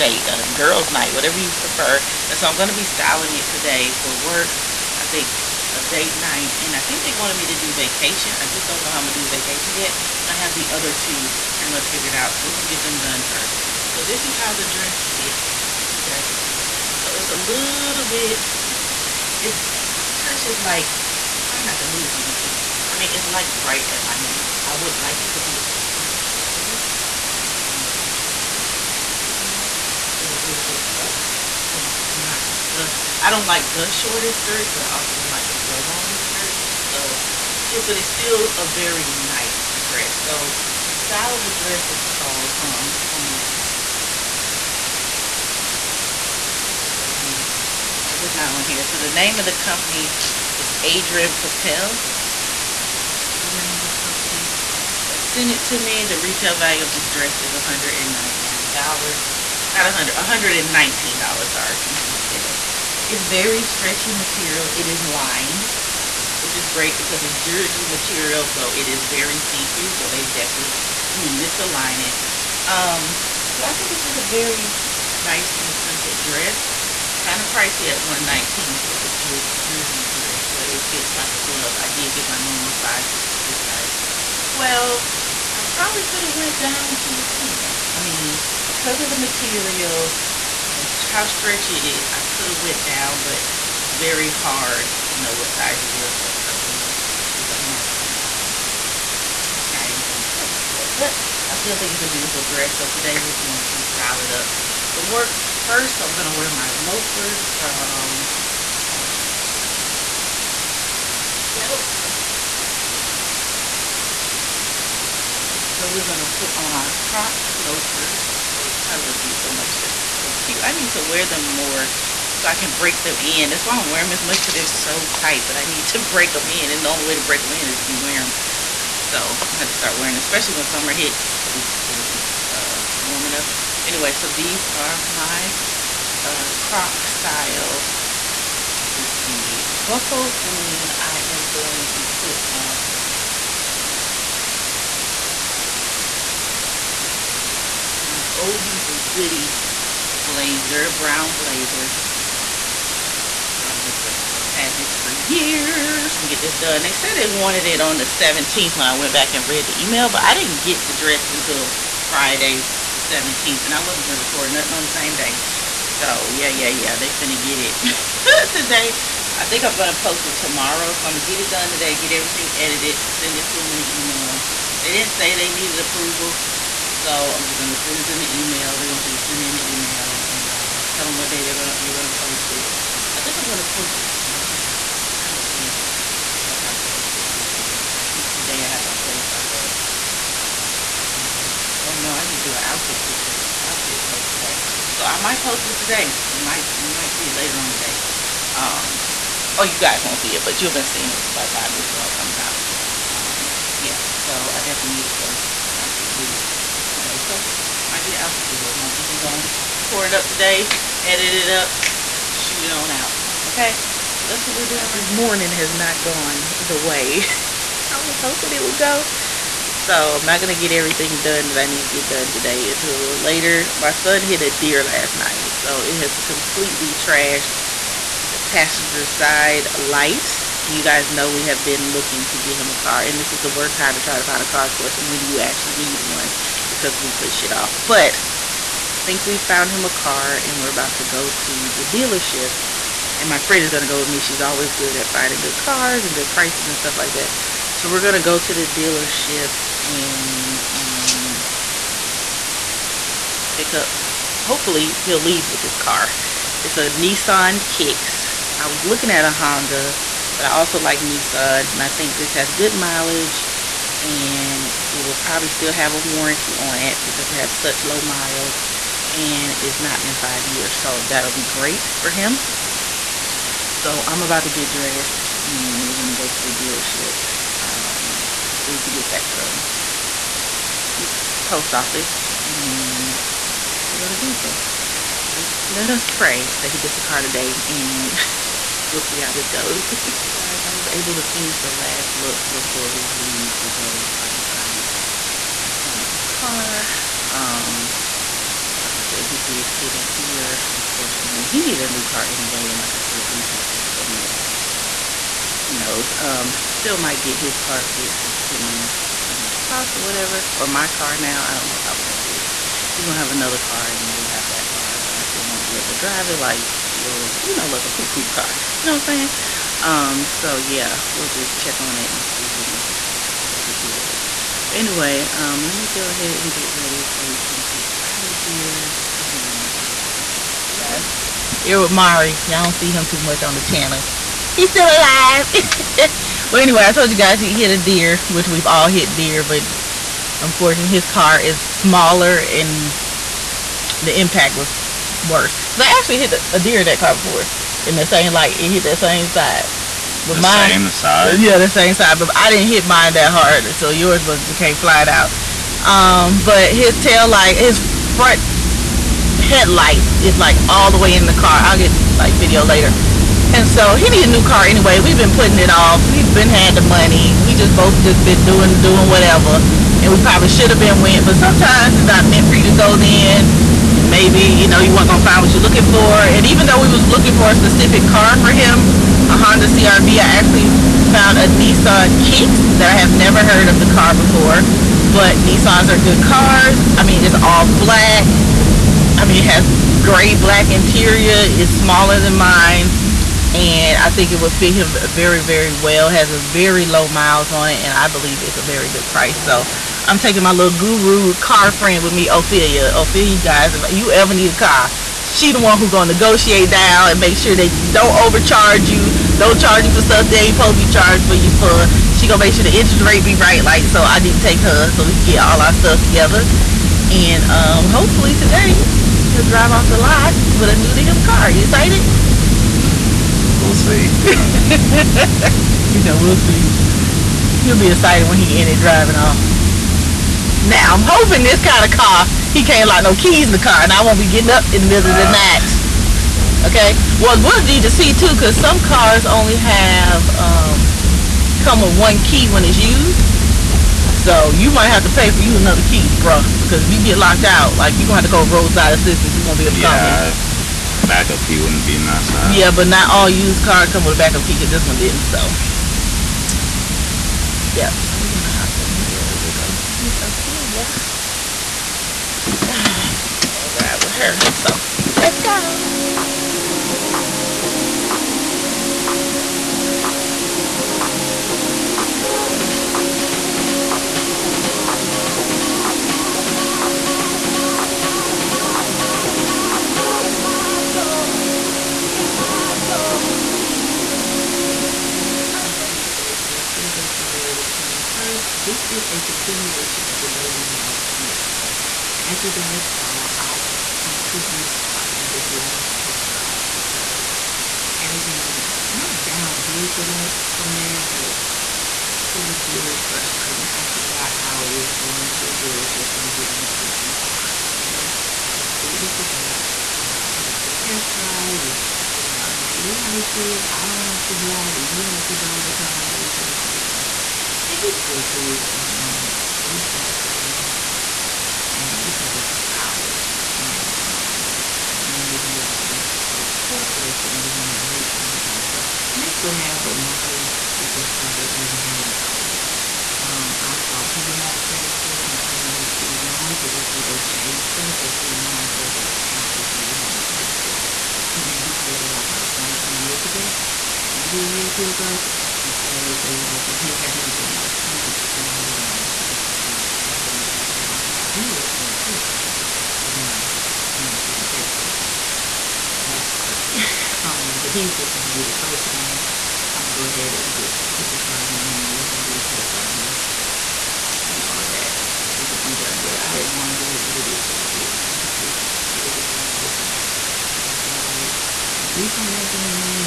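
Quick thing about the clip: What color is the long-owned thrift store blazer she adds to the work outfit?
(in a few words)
Brown.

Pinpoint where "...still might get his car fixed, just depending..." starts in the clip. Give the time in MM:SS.
05:06.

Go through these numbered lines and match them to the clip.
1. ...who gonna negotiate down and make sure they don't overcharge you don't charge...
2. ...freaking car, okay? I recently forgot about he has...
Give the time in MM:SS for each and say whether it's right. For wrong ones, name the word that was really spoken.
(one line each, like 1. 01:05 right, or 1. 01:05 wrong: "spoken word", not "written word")
1. 06:45 right
2. 08:26 wrong: "completely", not "recently".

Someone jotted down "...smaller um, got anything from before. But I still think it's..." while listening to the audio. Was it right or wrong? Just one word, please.
wrong.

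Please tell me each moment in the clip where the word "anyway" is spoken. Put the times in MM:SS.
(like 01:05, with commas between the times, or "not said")
02:13, 05:02, 05:24, 05:36, 06:04.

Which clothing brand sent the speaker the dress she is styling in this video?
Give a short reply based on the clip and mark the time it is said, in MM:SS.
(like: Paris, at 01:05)
Adrianna Papell, at 00:50.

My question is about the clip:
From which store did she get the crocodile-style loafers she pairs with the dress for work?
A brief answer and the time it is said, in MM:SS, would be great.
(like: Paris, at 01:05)
Belk, at 01:51.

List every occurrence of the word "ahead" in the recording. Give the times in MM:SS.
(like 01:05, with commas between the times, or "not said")
05:26, 09:20.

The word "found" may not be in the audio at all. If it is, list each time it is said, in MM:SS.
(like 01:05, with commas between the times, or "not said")
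03:59, 06:21.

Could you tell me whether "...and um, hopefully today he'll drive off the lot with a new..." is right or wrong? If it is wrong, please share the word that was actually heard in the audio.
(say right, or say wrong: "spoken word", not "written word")
right.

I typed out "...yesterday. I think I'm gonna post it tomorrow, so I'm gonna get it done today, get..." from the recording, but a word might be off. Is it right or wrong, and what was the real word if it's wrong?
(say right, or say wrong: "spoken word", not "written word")
wrong: "today", not "yesterday".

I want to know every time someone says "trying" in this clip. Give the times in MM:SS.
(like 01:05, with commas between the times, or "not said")
00:21, 03:05.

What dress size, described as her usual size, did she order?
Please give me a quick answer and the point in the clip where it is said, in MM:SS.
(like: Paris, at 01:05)
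12, at 01:23.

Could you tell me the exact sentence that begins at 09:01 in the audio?
And then he paid that off like one or two years ago maybe a year or two ago.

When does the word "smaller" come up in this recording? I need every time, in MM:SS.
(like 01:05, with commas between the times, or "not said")
05:41, 06:31.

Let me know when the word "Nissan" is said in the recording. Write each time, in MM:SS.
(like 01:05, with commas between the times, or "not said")
04:16, 04:20, 06:21, 06:25.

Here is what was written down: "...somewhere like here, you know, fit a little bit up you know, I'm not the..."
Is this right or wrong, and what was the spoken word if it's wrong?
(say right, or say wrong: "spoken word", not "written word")
right.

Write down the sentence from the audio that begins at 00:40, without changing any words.
So, the style of the dress is called, hold on, um, I think it's on here.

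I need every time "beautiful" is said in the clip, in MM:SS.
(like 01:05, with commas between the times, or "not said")
01:42.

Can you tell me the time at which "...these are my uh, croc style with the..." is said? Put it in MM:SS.
02:14.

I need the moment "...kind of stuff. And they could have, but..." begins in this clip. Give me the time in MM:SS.
08:48.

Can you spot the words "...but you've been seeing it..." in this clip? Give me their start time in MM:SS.
03:20.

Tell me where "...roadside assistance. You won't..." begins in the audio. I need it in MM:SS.
07:28.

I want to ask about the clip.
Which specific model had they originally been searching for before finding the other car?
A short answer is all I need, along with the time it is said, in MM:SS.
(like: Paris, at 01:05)
Honda CRV, at 06:19.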